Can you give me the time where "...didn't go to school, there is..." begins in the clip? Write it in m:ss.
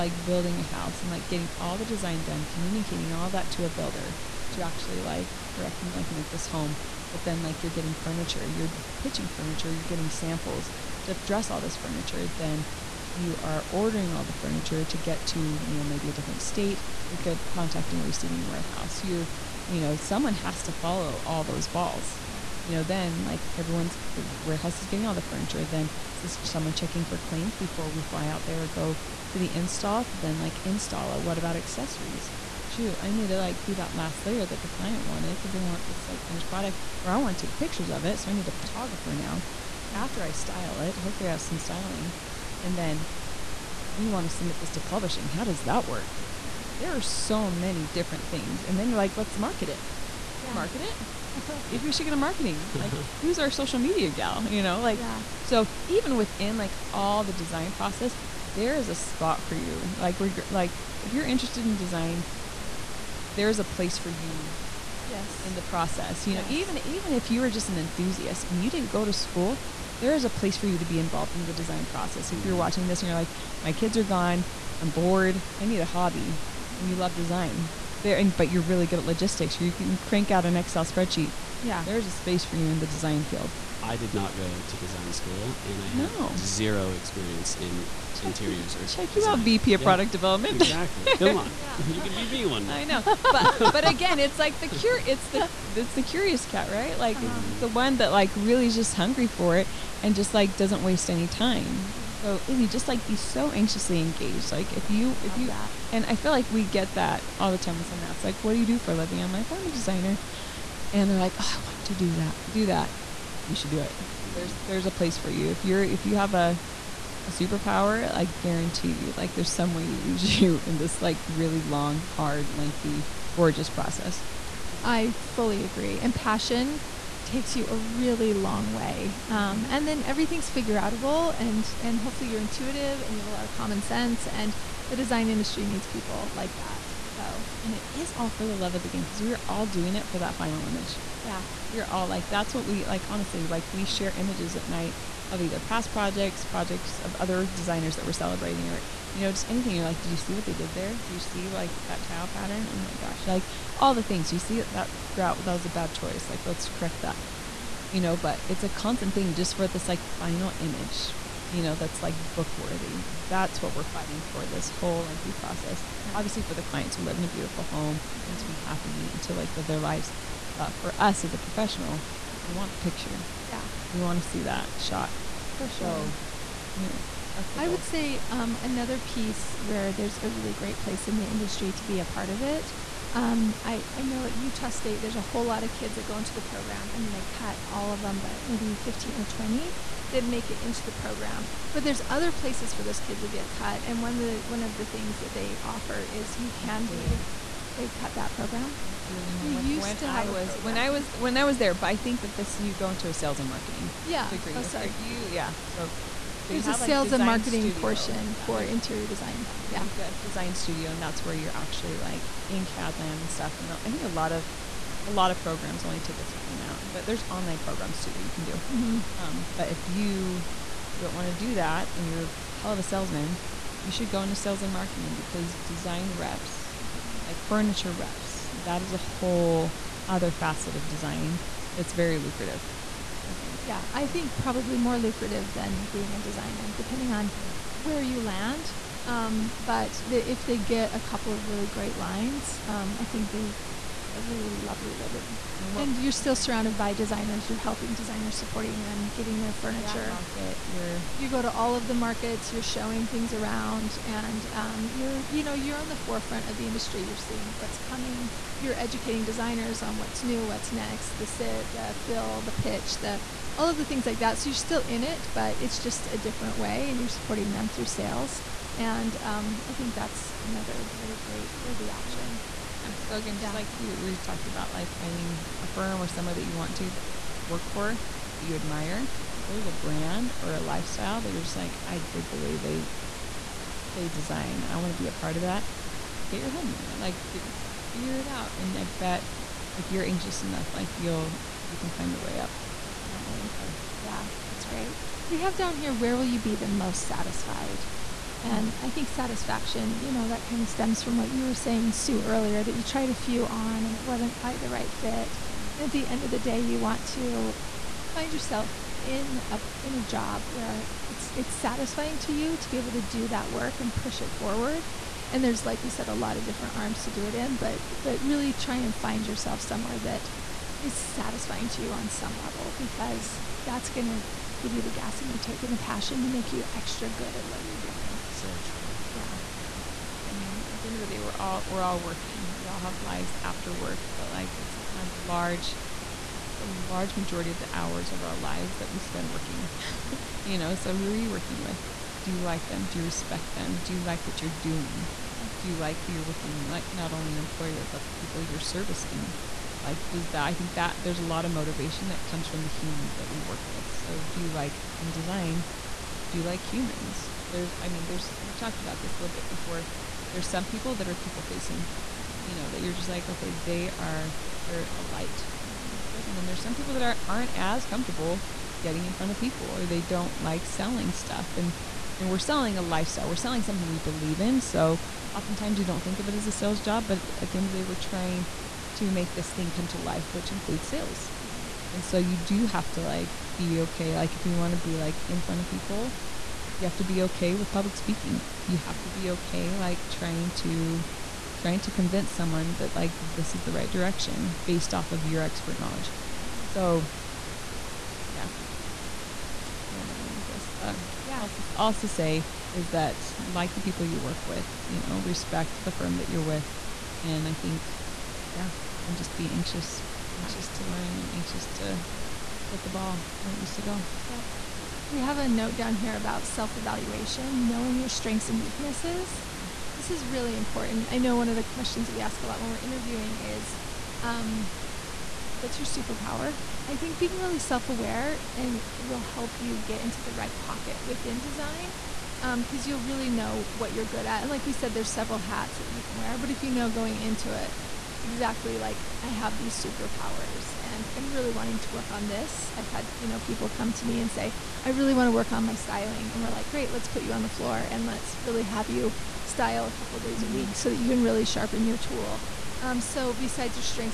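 1:08.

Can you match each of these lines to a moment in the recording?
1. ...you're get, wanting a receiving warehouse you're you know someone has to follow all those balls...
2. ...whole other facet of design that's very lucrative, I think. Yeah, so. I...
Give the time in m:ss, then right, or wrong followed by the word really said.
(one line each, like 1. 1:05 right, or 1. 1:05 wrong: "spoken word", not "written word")
1. 0:17 wrong: "contacting", not "wanting"
2. 3:48 right.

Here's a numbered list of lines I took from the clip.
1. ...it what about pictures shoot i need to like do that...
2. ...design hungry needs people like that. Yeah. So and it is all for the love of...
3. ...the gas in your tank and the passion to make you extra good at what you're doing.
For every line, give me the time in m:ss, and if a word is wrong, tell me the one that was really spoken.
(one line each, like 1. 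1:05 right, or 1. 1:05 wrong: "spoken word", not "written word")
1. 0:31 wrong: "accessories", not "pictures"
2. 2:14 wrong: "industry", not "hungry"
3. 5:24 right.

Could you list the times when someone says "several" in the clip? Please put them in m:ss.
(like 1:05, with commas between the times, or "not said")
7:15.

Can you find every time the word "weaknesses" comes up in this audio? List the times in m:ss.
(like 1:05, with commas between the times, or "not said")
6:58.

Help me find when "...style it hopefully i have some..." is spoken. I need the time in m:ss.
0:40.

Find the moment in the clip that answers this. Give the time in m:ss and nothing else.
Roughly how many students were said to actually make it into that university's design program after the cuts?
3:08.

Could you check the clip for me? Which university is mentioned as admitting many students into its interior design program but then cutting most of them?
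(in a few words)
Utah State.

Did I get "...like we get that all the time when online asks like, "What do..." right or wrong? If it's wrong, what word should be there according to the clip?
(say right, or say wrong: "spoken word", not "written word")
wrong: "someone", not "online".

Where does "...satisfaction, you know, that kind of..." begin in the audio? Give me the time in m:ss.
4:59.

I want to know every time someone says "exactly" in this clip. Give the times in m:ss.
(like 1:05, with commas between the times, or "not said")
1:30, 7:18.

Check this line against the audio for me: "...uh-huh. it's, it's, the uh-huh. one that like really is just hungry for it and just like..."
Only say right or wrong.
right.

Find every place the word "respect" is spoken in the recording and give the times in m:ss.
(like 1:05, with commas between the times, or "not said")
5:43, 6:45.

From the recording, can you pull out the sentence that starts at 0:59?
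Like, reg- like if you're interested in design, there's a place for you.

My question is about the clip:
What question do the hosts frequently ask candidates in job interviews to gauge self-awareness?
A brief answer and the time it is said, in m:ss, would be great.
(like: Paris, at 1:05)
What's your superpower?, at 7:05.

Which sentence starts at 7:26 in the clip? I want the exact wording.
And we're like, great, let's put you on the floor and let's really have you style a couple days mm -hmm.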